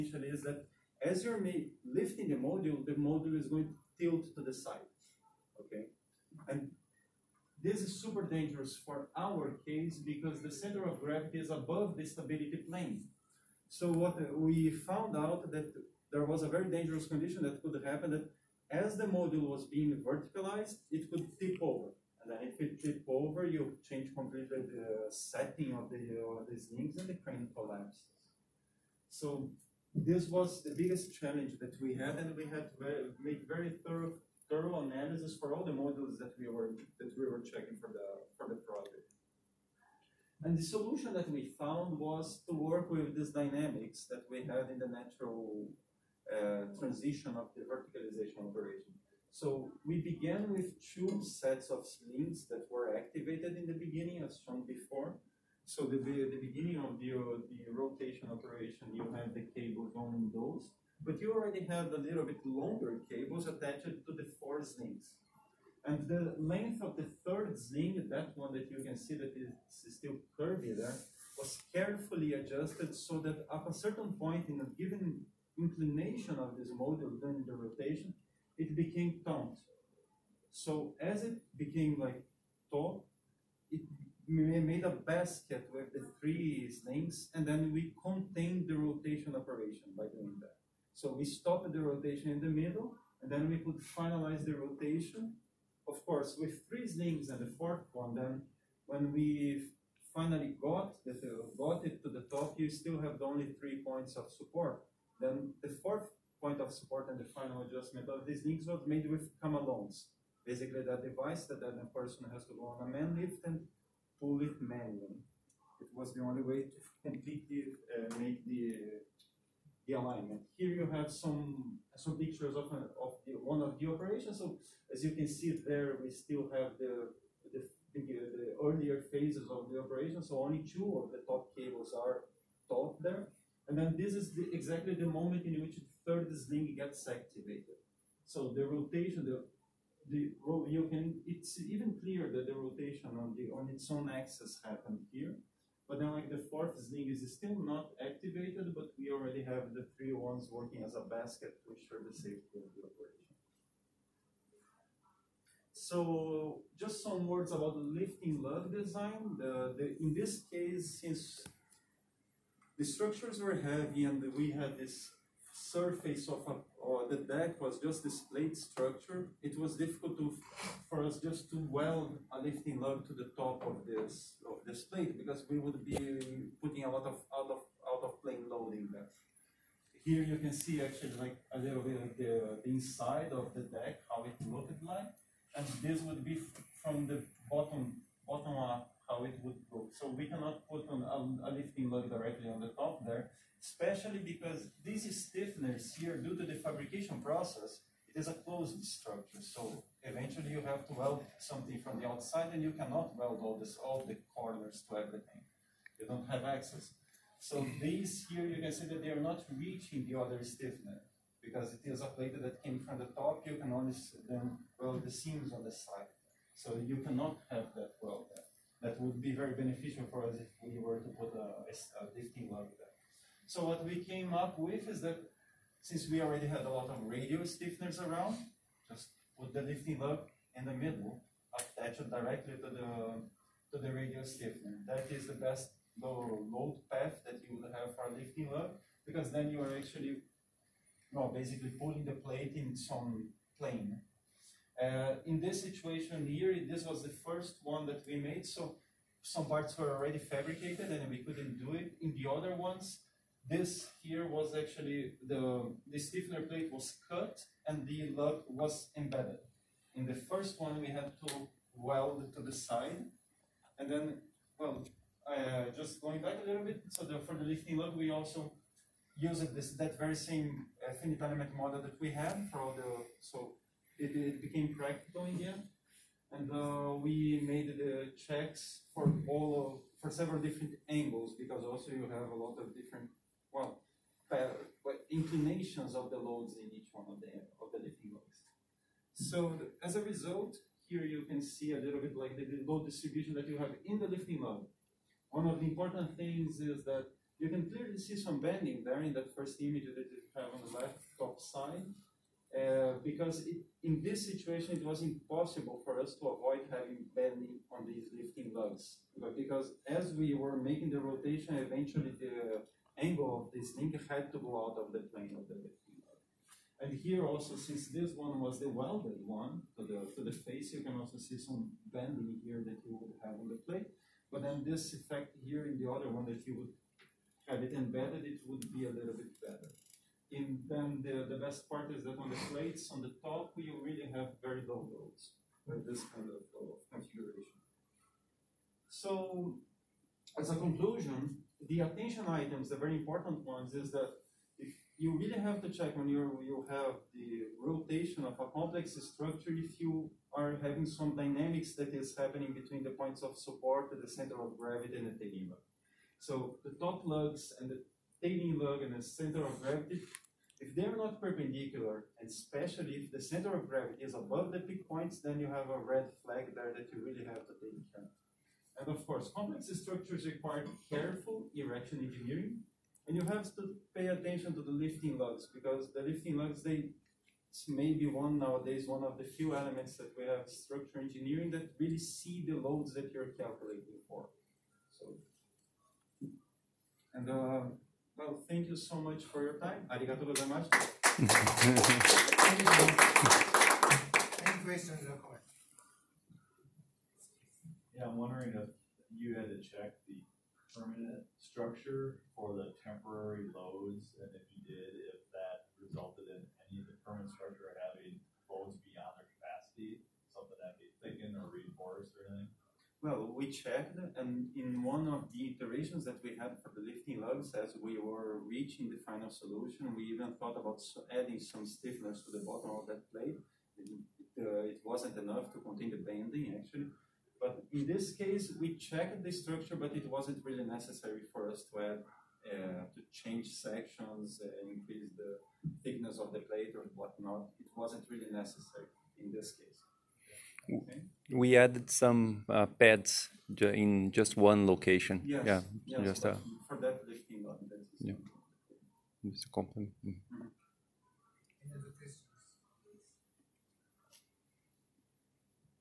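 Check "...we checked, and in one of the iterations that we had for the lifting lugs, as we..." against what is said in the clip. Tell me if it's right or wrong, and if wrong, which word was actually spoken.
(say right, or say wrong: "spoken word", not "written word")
right.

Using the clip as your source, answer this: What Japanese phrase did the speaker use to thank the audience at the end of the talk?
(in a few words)
Arigato gozaimasu.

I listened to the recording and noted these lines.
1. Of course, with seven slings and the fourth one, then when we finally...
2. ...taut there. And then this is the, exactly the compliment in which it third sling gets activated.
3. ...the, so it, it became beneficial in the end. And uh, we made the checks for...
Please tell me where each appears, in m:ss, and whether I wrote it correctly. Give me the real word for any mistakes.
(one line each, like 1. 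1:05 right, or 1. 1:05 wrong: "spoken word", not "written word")
1. 1:35 wrong: "three", not "seven"
2. 2:12 wrong: "moment", not "compliment"
3. 4:32 wrong: "practical", not "beneficial".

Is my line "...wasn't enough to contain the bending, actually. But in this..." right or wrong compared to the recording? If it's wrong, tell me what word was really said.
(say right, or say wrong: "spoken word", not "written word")
right.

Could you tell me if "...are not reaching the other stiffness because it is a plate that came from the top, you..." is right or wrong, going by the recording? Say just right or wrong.
right.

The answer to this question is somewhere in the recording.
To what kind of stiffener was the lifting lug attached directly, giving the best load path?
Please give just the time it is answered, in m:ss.
3:53.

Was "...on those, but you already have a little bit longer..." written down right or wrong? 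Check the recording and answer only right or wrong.
right.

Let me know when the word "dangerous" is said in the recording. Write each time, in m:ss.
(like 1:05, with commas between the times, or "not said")
0:08, 0:16.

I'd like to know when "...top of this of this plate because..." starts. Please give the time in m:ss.
2:53.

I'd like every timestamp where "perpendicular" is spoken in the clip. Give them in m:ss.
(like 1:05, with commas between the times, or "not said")
6:01.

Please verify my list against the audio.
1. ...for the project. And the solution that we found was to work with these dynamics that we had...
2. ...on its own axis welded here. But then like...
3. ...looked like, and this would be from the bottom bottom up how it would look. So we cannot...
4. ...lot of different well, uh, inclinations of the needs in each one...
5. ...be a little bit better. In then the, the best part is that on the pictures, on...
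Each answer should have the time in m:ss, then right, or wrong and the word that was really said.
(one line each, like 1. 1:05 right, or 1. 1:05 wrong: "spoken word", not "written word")
1. 0:38 right
2. 2:23 wrong: "happened", not "welded"
3. 3:04 right
4. 4:42 wrong: "loads", not "needs"
5. 5:28 wrong: "plates", not "pictures".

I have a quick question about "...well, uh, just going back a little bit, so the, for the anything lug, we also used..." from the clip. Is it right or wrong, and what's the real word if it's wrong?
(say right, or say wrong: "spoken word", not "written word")
wrong: "lifting", not "anything".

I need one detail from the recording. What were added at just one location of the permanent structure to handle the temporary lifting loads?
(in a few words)
pads.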